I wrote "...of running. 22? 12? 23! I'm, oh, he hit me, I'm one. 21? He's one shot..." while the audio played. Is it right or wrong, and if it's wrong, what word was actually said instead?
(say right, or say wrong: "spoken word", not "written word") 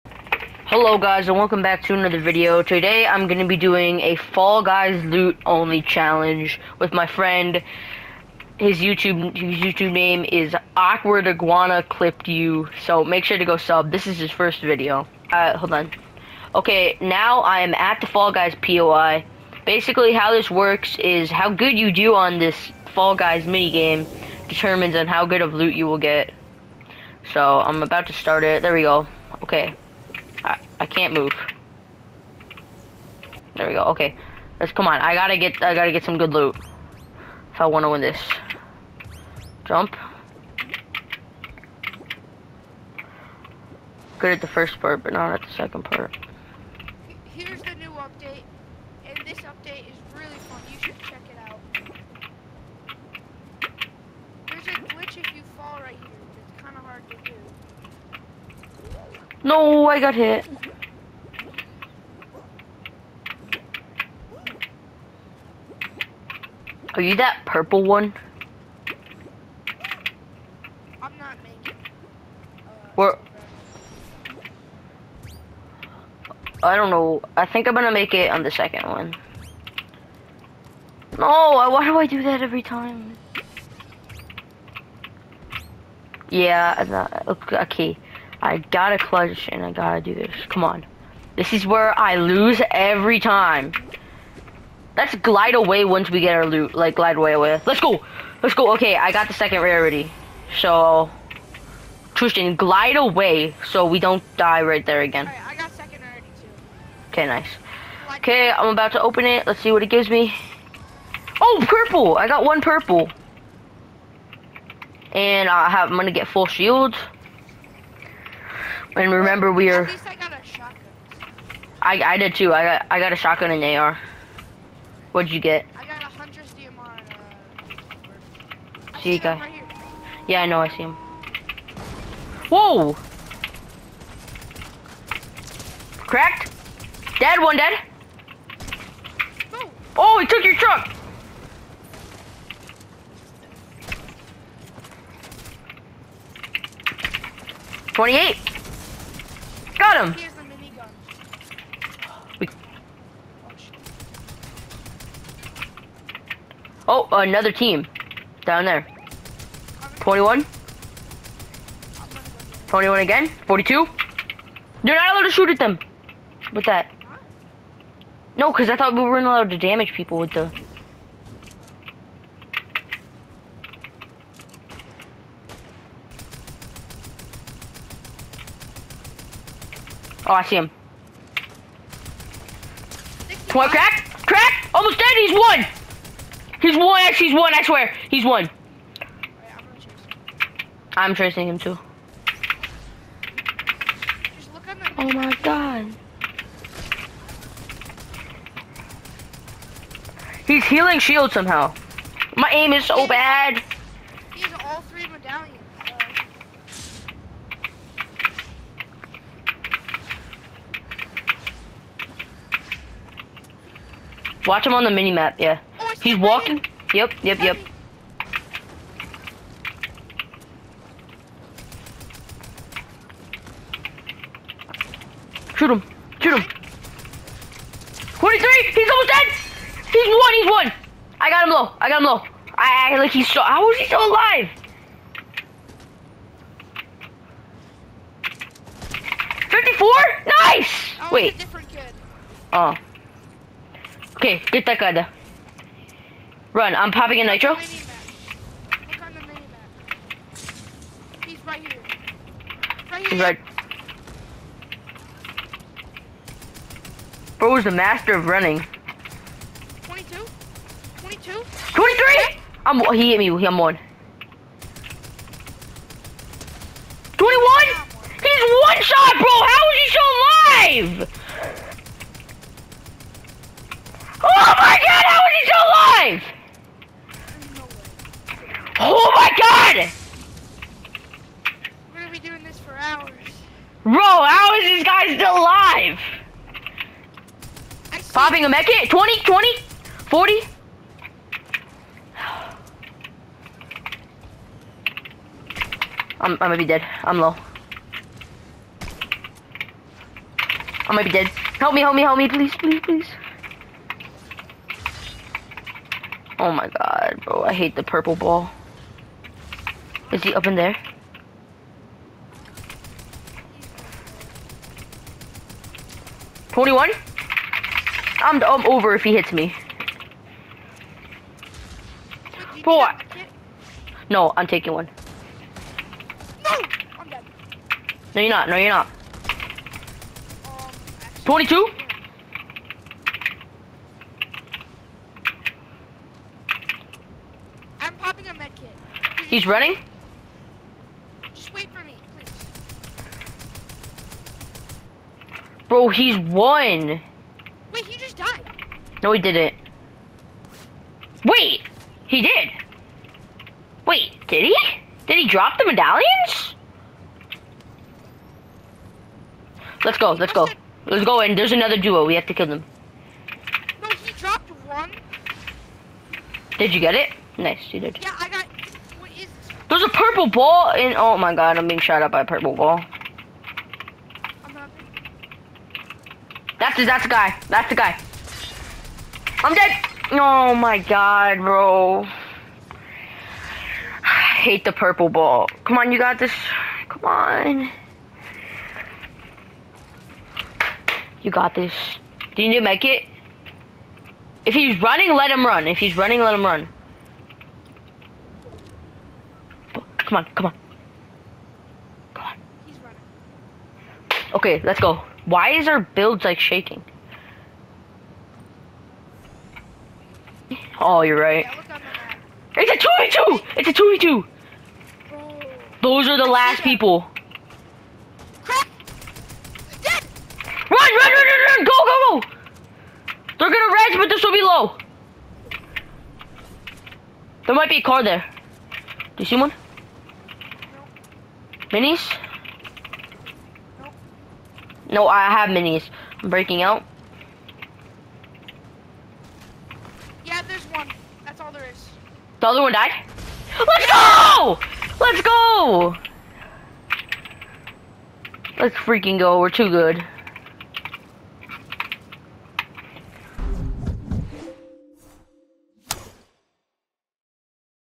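wrong: "22", not "12".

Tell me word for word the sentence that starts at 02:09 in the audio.
Right yeah, I know, I see him.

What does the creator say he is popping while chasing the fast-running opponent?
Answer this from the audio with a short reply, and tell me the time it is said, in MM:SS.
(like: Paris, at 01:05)
a nitro, at 04:06.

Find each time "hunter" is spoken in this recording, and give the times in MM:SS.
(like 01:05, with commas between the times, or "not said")
02:06.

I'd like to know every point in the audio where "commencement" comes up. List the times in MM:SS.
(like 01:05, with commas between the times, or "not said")
not said.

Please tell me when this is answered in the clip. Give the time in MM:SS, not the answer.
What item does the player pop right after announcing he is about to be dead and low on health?
04:48.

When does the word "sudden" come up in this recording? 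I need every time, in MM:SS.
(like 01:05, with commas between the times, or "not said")
not said.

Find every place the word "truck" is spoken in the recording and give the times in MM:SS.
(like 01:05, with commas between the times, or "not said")
02:20.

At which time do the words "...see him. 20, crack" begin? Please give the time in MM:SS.
03:00.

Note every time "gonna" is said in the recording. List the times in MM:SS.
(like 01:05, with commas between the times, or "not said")
01:17, 01:55, 04:56, 07:03.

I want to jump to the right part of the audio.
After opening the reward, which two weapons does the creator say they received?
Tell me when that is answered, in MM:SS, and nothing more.
02:03.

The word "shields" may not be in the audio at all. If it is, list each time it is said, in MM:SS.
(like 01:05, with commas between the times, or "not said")
01:56, 03:20.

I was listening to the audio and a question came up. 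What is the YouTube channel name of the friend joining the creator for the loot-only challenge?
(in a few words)
Awkward Iguana Clipped You.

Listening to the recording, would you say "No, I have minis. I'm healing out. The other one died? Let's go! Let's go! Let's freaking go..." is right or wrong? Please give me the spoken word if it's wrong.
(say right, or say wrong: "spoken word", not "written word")
wrong: "breaking", not "healing".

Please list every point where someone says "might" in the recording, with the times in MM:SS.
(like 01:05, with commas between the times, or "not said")
05:00, 07:07.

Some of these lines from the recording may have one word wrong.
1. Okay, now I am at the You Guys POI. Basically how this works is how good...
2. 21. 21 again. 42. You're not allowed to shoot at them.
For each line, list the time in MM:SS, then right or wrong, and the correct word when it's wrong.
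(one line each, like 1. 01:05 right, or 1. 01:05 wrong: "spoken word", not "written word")
1. 00:16 wrong: "Fall", not "You"
2. 02:40 right.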